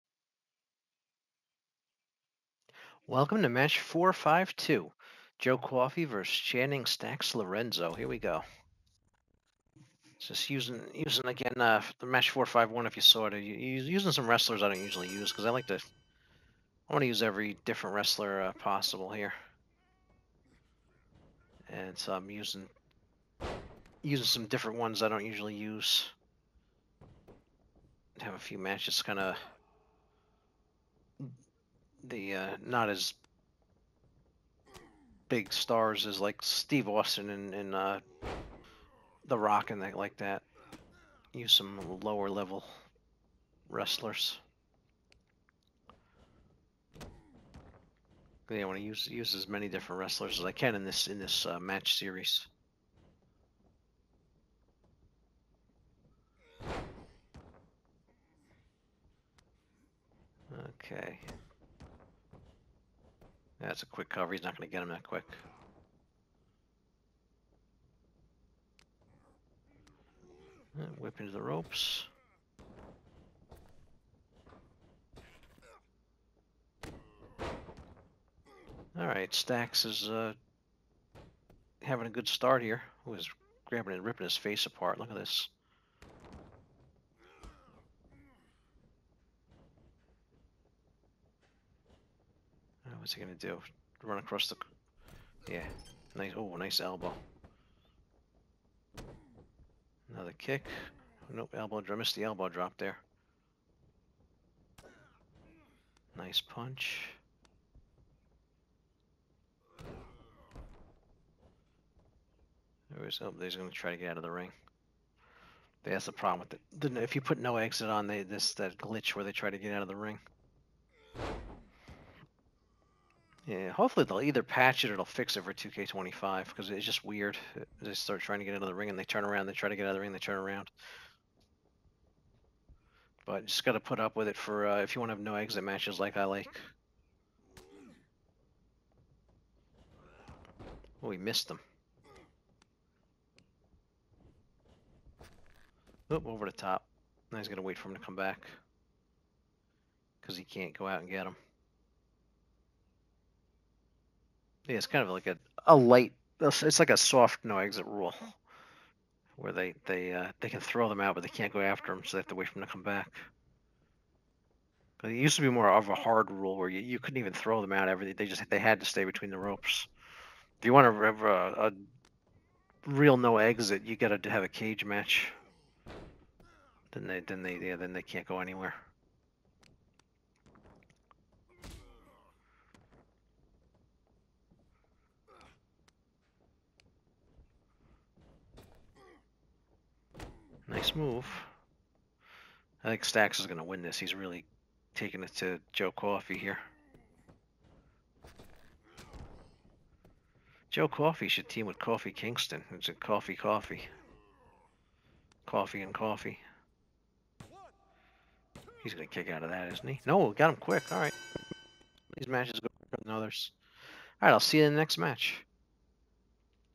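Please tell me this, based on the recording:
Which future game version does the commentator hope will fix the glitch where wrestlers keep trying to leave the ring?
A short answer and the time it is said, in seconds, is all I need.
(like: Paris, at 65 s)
2K25, at 125 s.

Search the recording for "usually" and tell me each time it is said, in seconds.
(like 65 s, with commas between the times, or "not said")
14 s, 25 s.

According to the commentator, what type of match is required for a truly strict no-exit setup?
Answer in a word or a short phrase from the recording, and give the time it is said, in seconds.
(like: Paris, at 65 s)
Cage match, at 174 s.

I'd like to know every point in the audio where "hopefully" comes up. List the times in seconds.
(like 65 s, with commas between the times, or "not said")
123 s.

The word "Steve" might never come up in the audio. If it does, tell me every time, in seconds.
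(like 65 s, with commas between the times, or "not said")
36 s.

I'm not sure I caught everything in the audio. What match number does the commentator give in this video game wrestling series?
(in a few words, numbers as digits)
452.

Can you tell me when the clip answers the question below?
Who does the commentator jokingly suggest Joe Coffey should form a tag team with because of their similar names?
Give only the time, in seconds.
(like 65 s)
201 s.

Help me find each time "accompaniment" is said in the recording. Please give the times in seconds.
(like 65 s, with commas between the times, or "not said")
not said.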